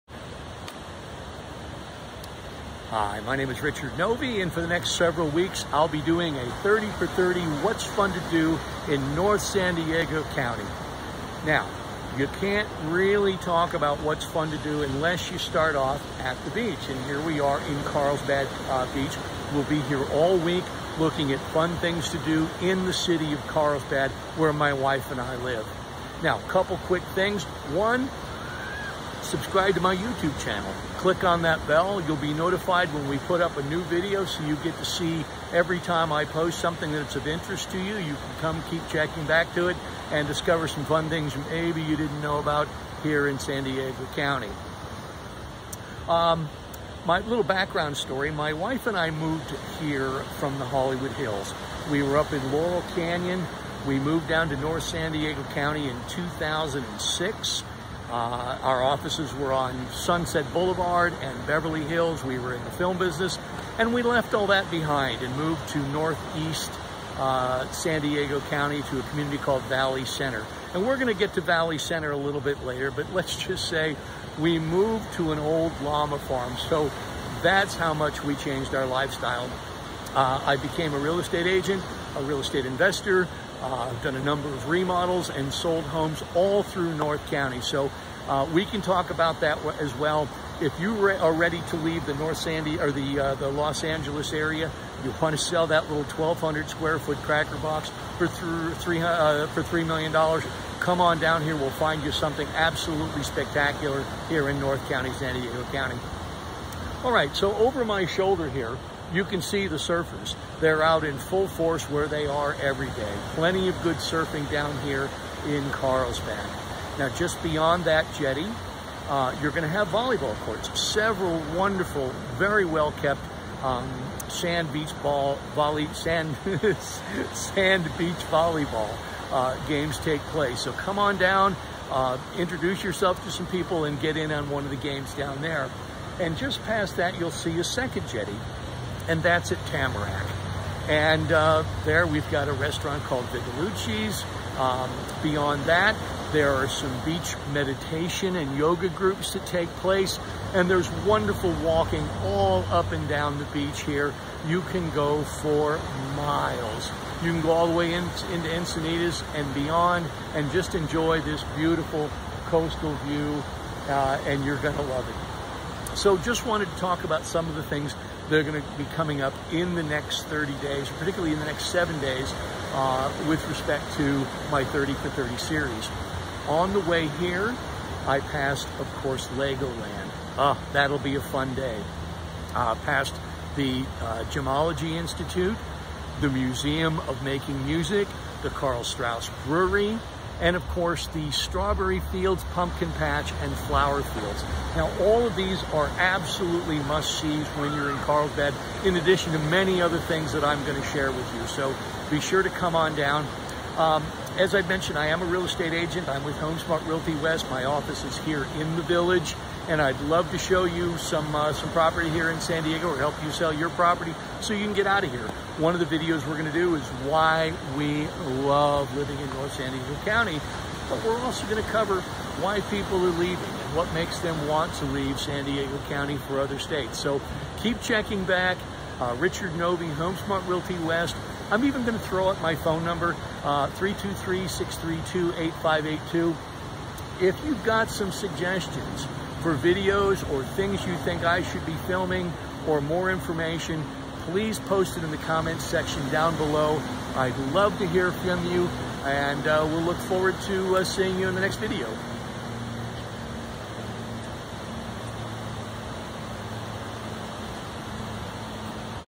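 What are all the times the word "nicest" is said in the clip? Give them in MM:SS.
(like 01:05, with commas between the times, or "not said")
not said.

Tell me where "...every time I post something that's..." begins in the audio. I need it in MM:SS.
00:35.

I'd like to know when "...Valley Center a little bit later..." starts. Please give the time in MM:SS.
01:11.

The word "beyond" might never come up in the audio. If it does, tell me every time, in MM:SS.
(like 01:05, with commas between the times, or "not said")
01:57, 02:25, 02:39.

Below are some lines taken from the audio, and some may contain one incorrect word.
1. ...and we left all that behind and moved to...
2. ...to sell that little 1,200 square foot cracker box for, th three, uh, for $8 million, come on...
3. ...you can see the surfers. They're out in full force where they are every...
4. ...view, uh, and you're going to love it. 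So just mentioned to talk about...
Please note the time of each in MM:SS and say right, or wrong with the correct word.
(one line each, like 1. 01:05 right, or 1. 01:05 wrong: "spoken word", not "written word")
1. 01:03 right
2. 01:35 wrong: "3", not "8"
3. 01:49 right
4. 02:43 wrong: "wanted", not "mentioned".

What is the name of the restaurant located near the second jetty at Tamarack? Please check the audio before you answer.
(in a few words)
Vigilucci's.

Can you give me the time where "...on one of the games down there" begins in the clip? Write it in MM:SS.
02:14.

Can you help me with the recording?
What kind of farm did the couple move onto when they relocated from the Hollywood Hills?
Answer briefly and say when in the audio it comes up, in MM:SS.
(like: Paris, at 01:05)
llama farm, at 01:15.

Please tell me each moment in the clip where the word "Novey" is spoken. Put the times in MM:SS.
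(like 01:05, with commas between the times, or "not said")
00:03, 03:49.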